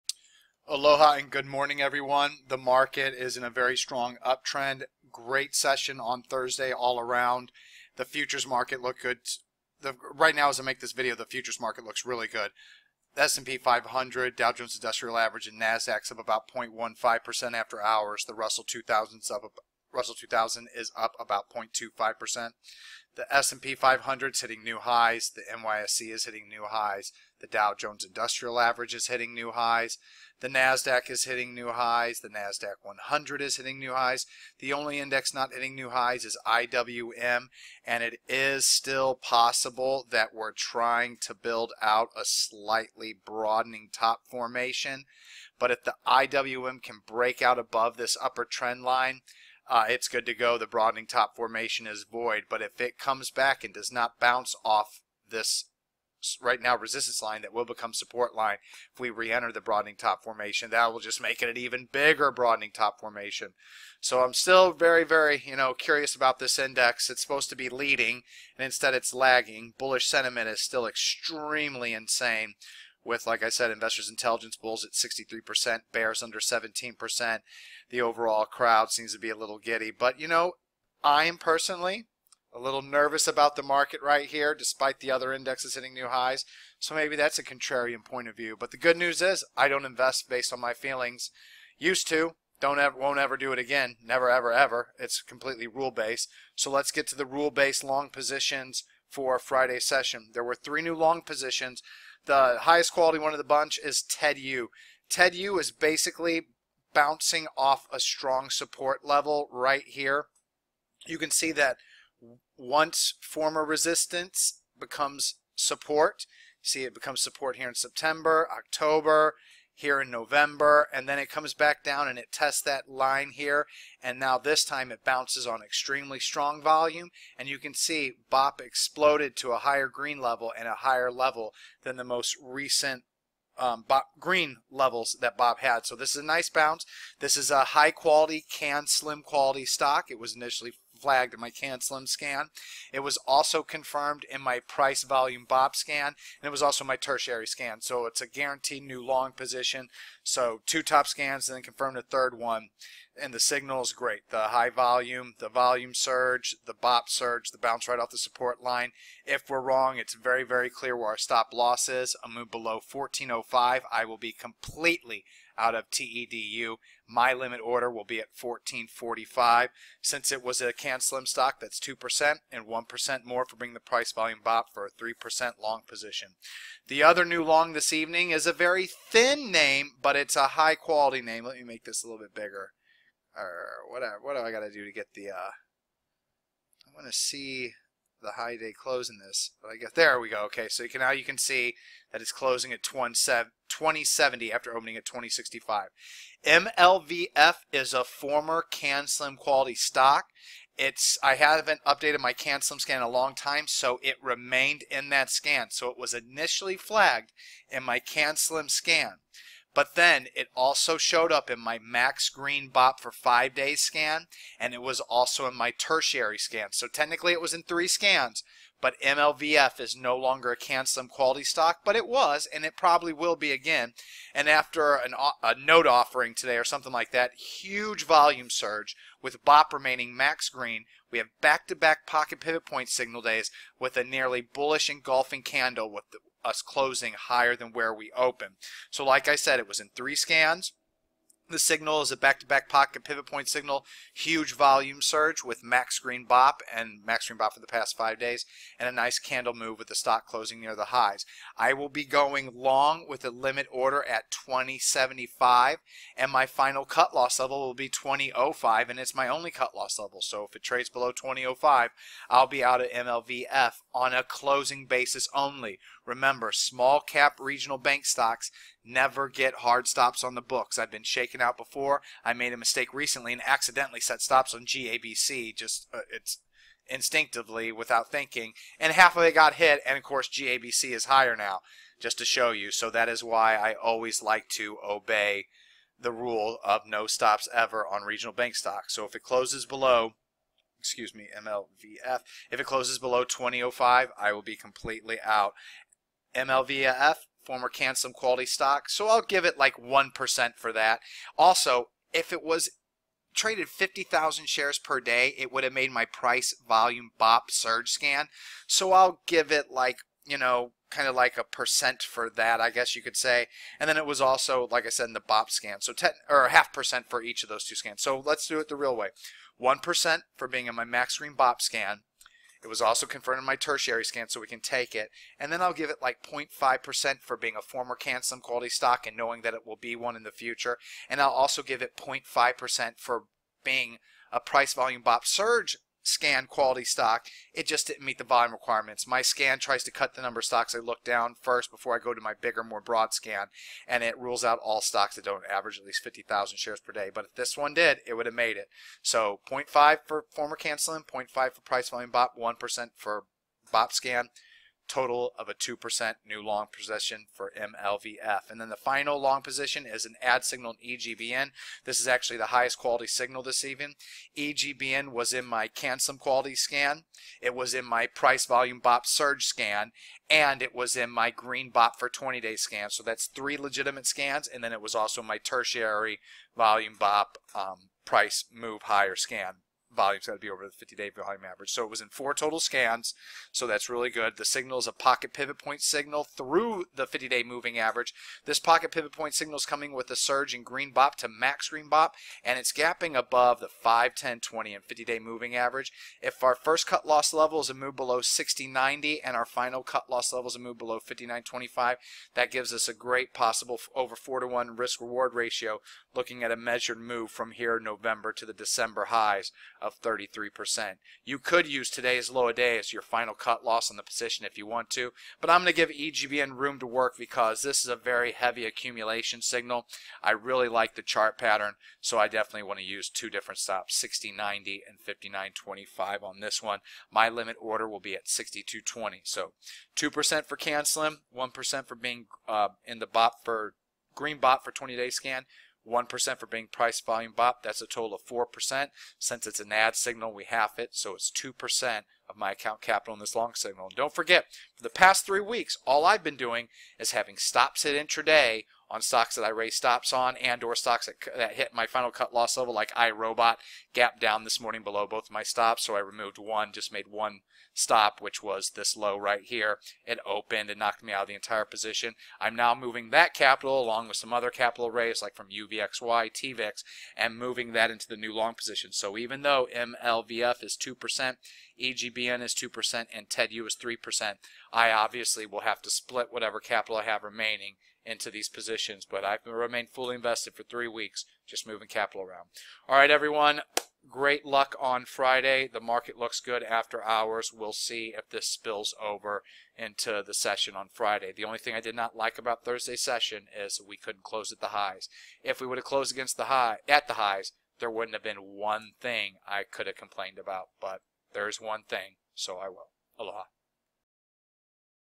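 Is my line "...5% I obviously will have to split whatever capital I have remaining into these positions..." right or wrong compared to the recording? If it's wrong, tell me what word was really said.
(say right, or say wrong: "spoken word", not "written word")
wrong: "3", not "5".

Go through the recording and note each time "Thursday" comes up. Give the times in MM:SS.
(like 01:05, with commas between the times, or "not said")
00:06, 08:12.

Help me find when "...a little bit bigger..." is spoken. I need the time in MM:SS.
03:02.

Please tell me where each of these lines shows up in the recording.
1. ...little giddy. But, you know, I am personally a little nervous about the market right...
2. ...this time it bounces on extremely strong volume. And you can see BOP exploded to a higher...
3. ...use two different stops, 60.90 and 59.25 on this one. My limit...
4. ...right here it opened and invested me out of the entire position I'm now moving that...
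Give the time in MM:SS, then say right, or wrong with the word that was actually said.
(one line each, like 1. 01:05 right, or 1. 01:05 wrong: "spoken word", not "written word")
1. 01:19 right
2. 02:04 right
3. 07:02 right
4. 07:39 wrong: "knocked", not "invested".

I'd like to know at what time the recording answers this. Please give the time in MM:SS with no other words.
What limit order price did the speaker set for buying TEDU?
02:48.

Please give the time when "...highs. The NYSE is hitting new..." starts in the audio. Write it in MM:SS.
00:24.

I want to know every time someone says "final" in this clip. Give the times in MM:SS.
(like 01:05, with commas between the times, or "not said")
04:16, 05:58, 06:39, 06:53, 07:31.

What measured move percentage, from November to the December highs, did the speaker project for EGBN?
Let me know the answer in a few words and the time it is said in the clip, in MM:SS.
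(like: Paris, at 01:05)
33%, at 06:50.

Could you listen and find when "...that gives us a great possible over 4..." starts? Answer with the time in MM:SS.
06:42.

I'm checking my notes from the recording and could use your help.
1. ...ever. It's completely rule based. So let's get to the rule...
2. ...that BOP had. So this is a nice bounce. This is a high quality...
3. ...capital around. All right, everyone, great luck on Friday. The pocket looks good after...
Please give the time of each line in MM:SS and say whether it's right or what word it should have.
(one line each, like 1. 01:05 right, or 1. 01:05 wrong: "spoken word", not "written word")
1. 01:34 right
2. 02:15 right
3. 08:01 wrong: "market", not "pocket".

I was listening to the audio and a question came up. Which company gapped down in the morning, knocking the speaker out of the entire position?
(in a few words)
iRobot.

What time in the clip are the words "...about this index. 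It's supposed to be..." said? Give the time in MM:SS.
01:06.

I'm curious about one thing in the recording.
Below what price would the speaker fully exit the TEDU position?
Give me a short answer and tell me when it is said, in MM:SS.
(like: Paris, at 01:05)
14.05, at 02:42.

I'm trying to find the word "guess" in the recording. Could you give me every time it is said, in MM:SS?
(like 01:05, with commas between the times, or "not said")
03:09, 05:12.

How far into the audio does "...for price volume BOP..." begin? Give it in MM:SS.
05:51.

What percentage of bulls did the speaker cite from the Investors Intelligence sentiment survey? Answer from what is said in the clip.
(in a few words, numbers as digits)
63%.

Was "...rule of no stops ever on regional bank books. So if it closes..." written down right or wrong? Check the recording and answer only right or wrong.
wrong.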